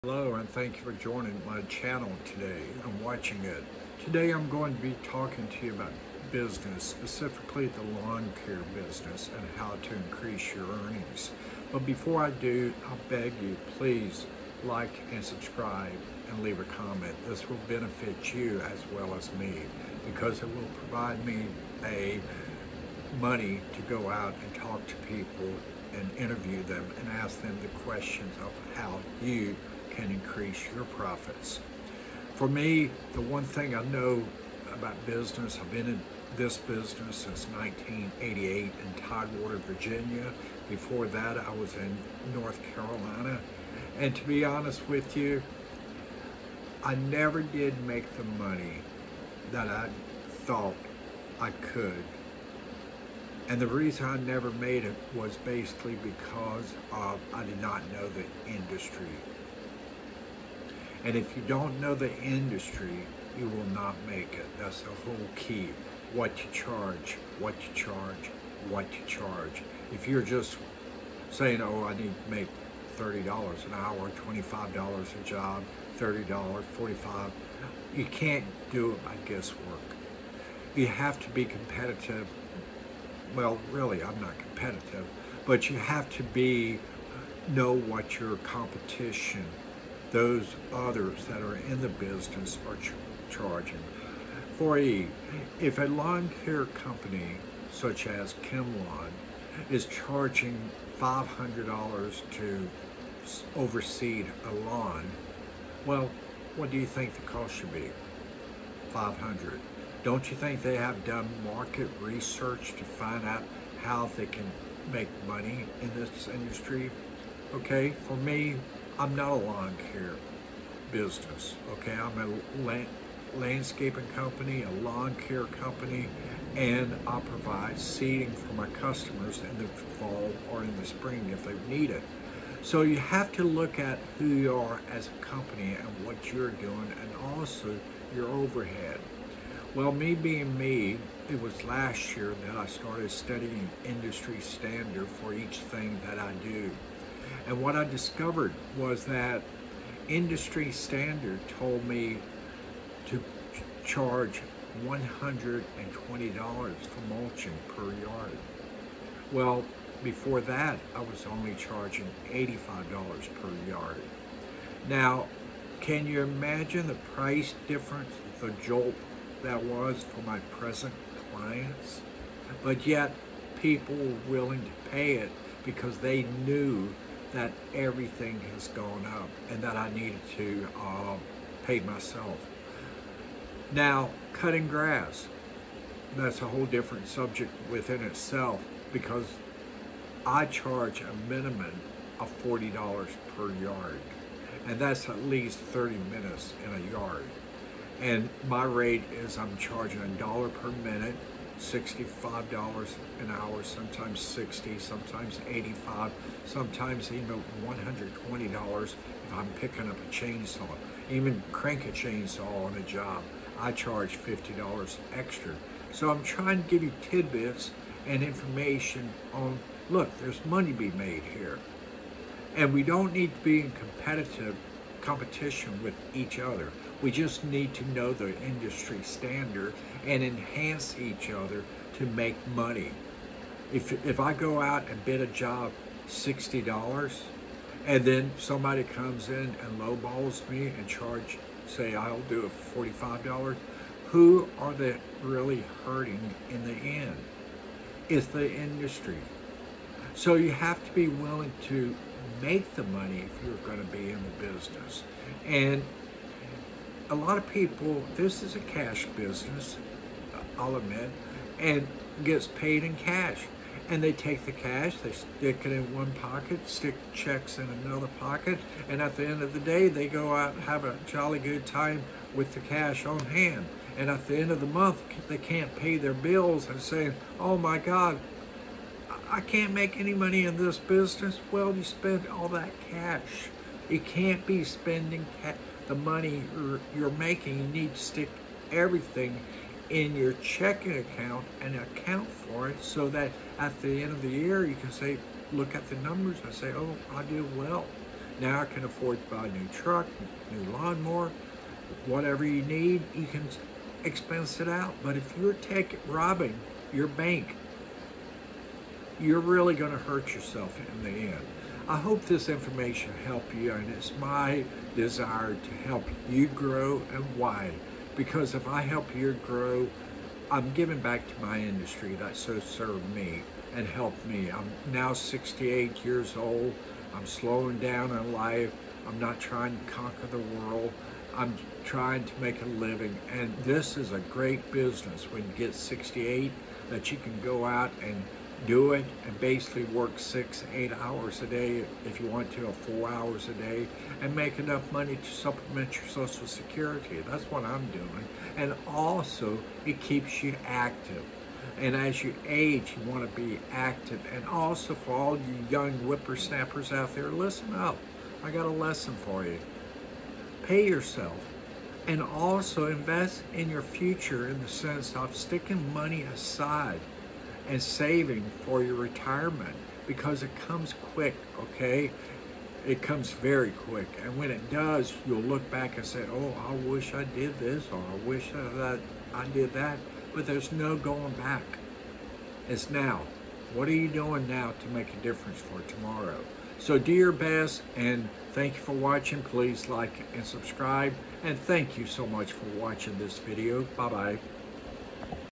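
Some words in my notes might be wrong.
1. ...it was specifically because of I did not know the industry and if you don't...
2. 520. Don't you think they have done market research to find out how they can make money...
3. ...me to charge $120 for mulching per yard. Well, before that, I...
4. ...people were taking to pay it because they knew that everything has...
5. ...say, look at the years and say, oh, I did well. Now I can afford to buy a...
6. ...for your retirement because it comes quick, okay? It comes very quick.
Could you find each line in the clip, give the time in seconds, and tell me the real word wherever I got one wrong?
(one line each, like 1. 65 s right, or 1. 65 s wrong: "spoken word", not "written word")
1. 54 s wrong: "basically", not "specifically"
2. 108 s wrong: "500", not "520"
3. 151 s right
4. 173 s wrong: "willing", not "taking"
5. 294 s wrong: "numbers", not "years"
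6. 368 s right.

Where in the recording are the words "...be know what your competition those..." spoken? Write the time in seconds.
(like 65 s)
86 s.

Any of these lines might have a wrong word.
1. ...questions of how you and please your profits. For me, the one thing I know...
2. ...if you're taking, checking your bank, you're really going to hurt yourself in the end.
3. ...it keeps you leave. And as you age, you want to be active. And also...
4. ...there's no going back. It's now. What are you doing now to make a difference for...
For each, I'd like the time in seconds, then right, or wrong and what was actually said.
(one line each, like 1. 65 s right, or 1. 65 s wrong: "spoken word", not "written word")
1. 27 s wrong: "increase", not "please"
2. 305 s wrong: "robbing", not "checking"
3. 349 s wrong: "active", not "leave"
4. 380 s right.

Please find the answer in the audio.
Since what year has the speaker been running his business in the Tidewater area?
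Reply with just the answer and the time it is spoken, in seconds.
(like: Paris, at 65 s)
1988, at 37 s.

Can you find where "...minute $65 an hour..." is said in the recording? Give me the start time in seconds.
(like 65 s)
200 s.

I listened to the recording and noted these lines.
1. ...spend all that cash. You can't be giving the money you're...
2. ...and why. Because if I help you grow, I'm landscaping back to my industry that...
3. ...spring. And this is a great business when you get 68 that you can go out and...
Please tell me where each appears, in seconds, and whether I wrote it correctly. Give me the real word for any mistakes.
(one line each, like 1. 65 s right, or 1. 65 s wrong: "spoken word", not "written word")
1. 281 s wrong: "spending", not "giving"
2. 317 s wrong: "giving", not "landscaping"
3. 332 s wrong: "living", not "spring".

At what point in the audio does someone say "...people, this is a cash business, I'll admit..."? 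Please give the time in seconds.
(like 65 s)
257 s.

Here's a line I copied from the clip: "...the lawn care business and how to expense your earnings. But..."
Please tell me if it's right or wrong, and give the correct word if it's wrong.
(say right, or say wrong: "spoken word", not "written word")
wrong: "increase", not "expense".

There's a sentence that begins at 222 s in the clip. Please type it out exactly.
And we don't need to be in competitive competition with each other.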